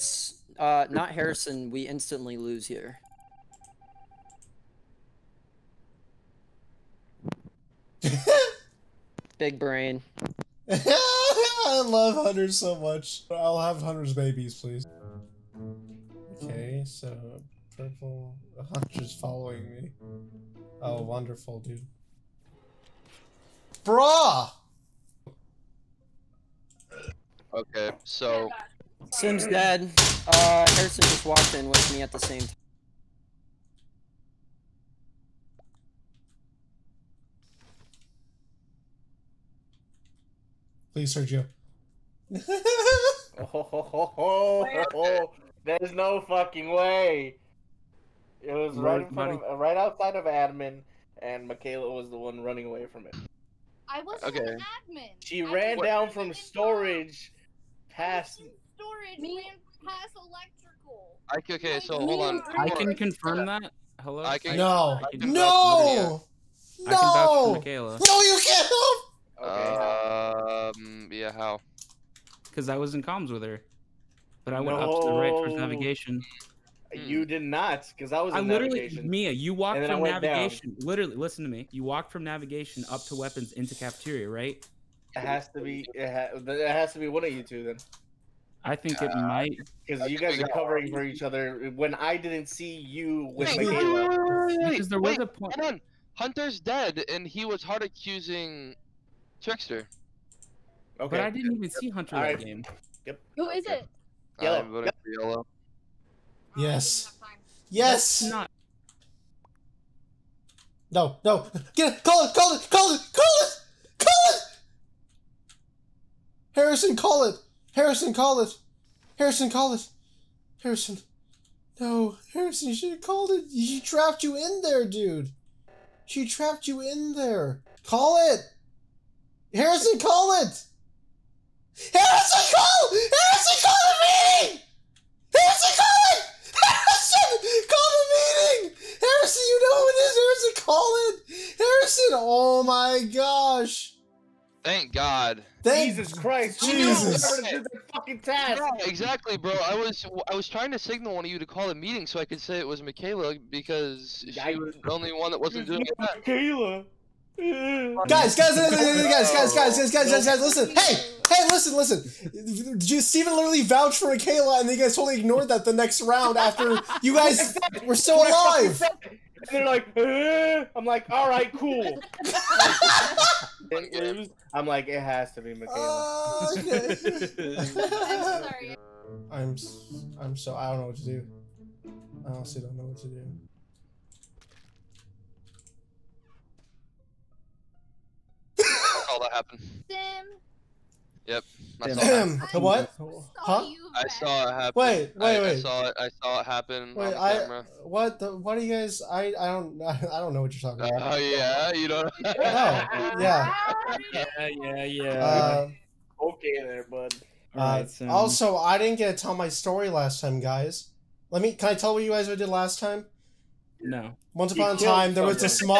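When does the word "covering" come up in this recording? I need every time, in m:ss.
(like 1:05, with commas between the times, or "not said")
1:30.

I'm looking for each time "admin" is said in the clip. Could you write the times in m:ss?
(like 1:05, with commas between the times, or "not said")
0:50, 0:54.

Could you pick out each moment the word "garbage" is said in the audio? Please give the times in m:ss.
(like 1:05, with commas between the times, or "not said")
not said.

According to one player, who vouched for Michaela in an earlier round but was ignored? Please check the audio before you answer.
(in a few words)
Steven.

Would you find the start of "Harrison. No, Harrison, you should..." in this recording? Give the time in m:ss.
2:00.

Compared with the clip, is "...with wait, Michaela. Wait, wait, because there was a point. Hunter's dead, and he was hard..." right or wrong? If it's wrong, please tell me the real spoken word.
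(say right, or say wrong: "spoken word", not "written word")
right.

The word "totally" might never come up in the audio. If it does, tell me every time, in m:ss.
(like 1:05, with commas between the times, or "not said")
2:44.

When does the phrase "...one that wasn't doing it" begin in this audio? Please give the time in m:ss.
2:35.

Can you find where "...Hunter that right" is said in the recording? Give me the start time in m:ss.
1:41.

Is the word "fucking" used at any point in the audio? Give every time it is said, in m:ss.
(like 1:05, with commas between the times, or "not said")
0:46, 2:27.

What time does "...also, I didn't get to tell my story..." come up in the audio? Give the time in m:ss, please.
3:28.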